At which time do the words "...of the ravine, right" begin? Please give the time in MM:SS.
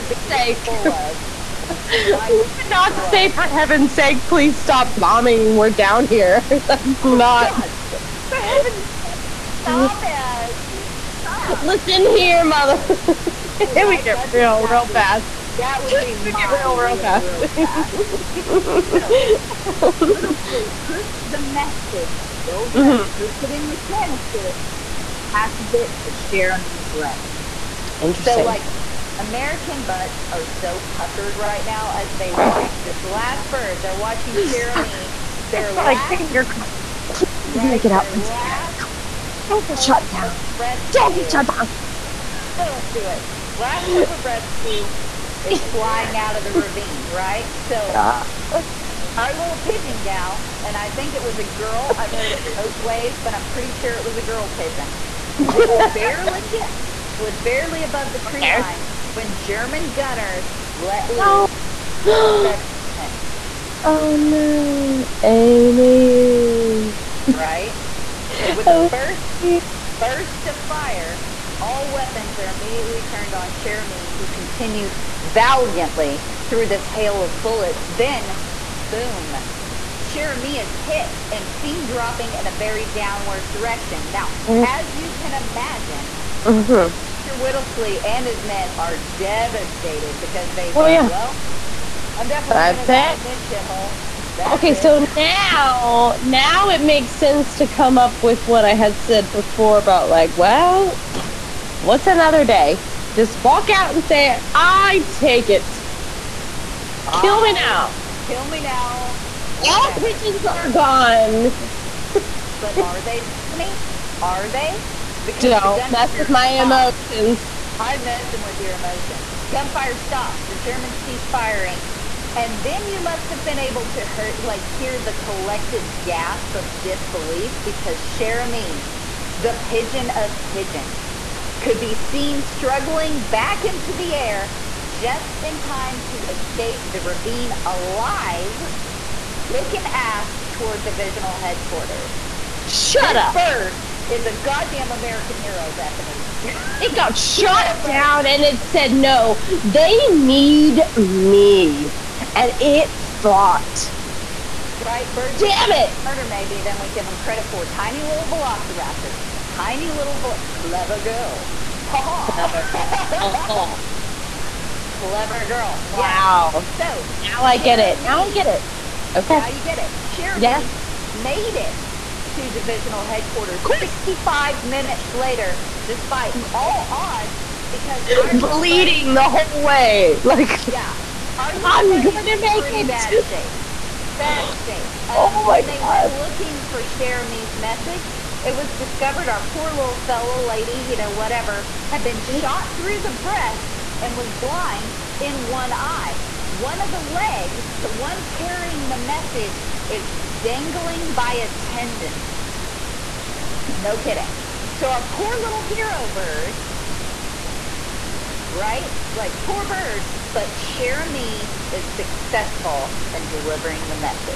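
00:46.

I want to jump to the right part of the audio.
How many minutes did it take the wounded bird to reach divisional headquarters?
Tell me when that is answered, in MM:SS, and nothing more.
02:53.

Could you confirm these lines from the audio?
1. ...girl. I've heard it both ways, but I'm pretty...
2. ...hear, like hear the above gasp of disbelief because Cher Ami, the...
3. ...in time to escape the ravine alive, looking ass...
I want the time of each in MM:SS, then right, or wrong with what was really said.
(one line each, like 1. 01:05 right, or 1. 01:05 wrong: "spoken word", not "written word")
1. 00:51 right
2. 02:03 wrong: "collective", not "above"
3. 02:15 right.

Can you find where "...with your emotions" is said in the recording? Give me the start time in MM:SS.
01:58.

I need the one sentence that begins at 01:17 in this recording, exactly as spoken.
Then, boom, Cher Ami is hit and seen dropping in a very downward direction.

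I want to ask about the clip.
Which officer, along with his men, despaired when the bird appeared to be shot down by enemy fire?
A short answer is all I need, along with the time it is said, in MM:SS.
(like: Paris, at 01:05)
Major Whittlesey, at 01:27.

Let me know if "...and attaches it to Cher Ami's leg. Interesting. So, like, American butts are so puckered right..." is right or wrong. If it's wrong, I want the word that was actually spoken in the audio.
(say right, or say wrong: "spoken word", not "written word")
right.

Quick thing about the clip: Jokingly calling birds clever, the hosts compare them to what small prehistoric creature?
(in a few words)
velociraptors.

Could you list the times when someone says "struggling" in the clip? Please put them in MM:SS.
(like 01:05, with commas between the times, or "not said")
02:12.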